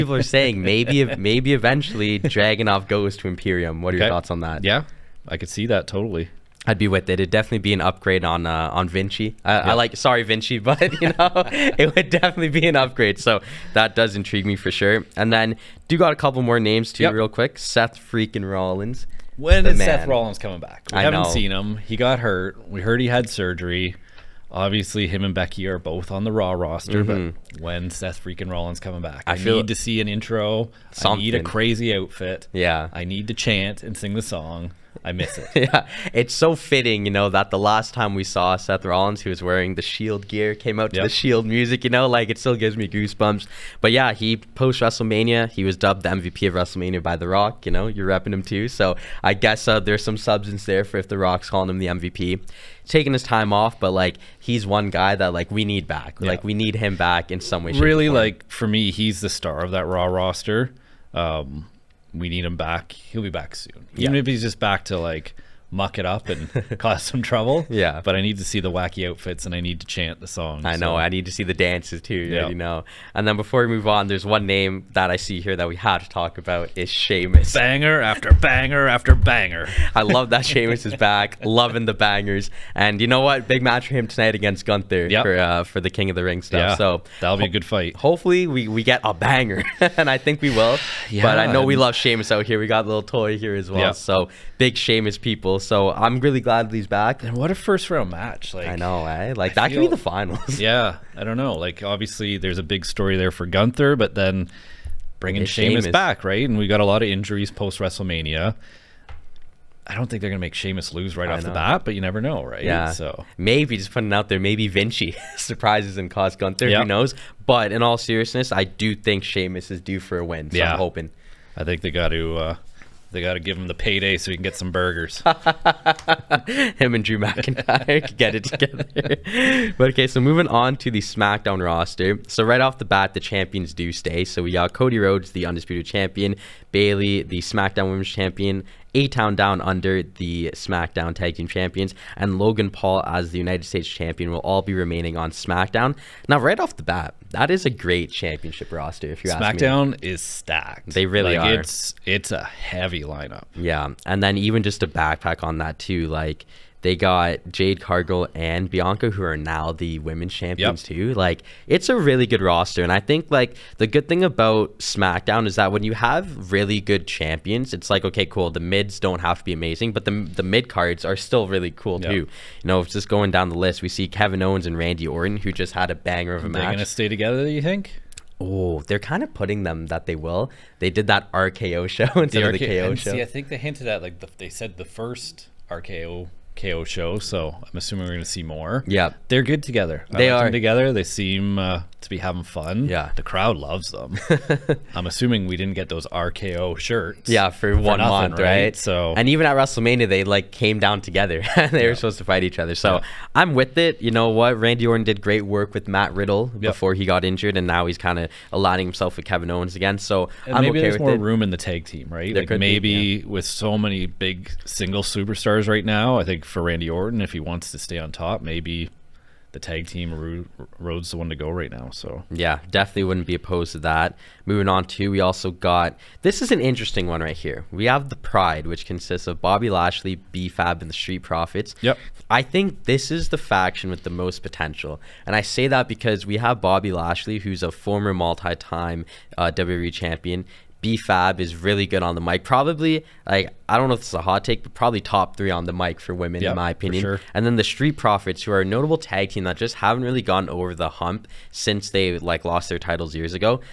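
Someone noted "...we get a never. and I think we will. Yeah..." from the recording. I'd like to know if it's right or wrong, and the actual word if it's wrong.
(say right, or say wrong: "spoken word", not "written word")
wrong: "banger", not "never".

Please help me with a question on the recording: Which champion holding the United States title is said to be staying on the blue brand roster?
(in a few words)
Logan Paul.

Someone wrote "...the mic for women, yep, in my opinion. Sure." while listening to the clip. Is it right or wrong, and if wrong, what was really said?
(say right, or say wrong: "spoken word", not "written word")
right.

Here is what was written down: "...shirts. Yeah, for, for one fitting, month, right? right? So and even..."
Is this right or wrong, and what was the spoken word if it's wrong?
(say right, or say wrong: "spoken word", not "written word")
wrong: "nothing", not "fitting".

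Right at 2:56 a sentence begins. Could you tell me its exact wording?
They're gonna stay together, you think?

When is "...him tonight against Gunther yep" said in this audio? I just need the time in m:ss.
1:23.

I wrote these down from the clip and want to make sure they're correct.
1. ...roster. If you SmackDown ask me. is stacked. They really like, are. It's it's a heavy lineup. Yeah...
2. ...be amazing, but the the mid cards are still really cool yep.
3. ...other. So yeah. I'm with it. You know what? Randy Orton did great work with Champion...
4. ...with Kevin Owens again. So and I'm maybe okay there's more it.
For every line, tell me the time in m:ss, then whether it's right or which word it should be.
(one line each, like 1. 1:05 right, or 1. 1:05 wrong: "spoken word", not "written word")
1. 2:28 right
2. 2:49 right
3. 3:22 wrong: "Matt", not "Champion"
4. 3:29 right.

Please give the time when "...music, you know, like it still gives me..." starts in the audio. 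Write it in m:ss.
0:41.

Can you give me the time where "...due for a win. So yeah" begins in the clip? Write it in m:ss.
1:59.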